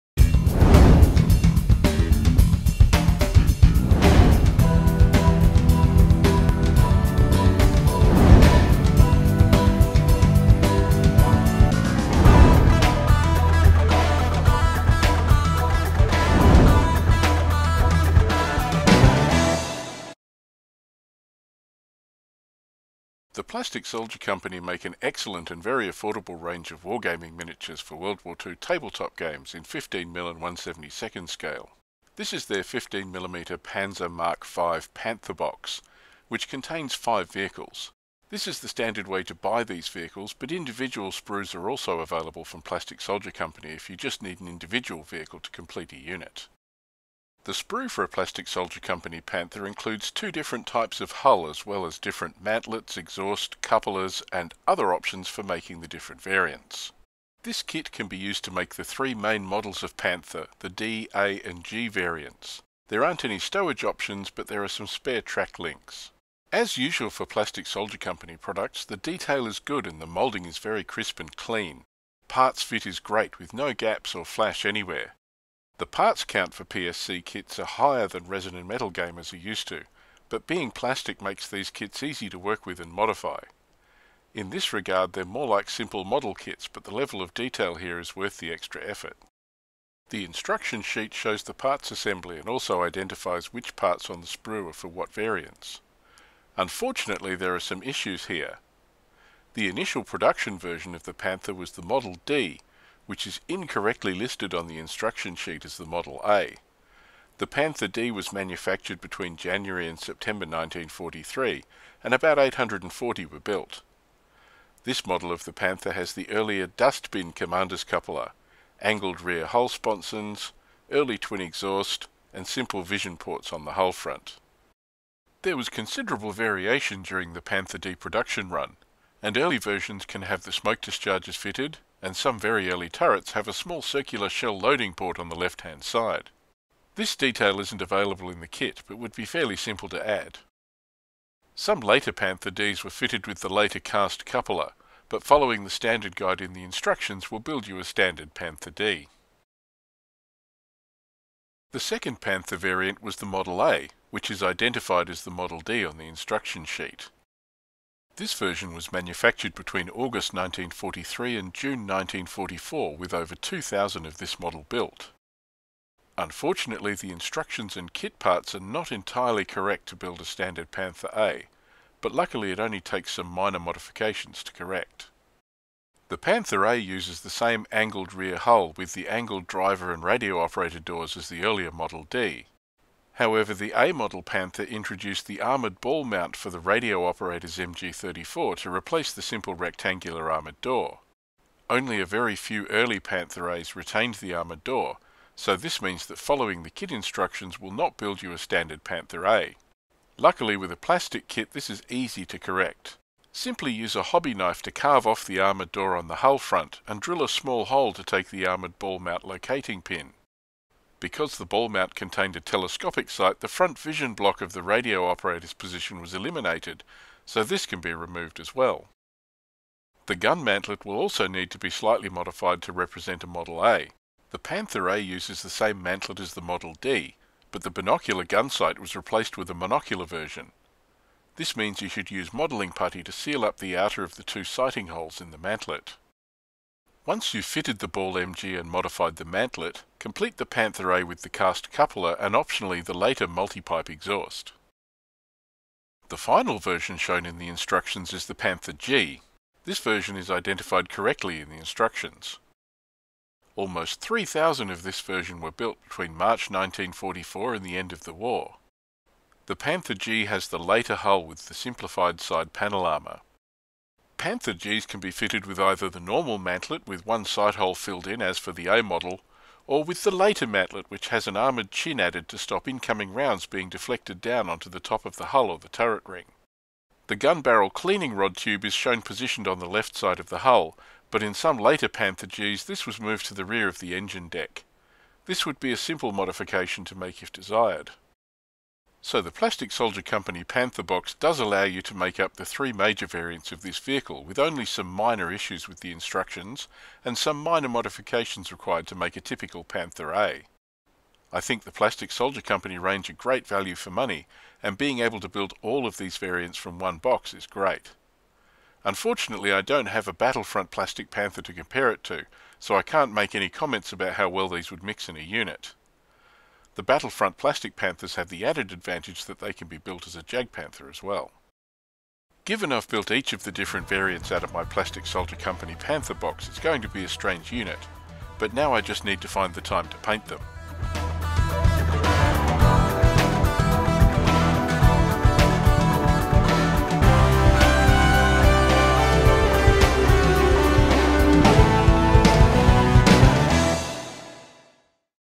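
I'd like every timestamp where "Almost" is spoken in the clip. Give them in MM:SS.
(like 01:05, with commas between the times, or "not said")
04:13.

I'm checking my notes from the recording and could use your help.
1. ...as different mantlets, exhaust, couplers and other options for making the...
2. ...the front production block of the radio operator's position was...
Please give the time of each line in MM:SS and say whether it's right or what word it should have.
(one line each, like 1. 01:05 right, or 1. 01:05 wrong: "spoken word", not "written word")
1. 00:51 right
2. 03:33 wrong: "vision", not "production".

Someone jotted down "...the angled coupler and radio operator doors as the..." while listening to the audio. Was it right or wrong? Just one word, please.
wrong.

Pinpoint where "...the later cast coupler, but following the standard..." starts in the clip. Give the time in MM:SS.
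02:23.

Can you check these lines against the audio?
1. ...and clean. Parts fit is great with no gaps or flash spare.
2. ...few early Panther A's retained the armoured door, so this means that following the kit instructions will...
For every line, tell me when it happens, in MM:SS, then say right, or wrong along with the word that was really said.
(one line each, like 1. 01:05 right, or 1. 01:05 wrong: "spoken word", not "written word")
1. 01:11 wrong: "anywhere", not "spare"
2. 03:12 right.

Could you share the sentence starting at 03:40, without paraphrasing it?
The gun mantlet will also need to be slightly modified to represent a Model A.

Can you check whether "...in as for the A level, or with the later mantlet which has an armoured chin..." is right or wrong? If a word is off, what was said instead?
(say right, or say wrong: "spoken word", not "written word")
wrong: "model", not "level".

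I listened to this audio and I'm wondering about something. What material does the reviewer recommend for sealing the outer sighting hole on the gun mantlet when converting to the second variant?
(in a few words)
modelling putty.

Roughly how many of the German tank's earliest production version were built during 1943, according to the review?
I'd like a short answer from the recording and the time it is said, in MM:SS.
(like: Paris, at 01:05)
840, at 01:52.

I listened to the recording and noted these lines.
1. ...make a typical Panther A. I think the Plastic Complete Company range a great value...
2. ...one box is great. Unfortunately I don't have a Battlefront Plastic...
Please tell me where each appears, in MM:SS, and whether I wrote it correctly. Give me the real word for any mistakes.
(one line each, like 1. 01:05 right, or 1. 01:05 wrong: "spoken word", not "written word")
1. 04:58 wrong: "Soldier", not "Complete"
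2. 05:06 right.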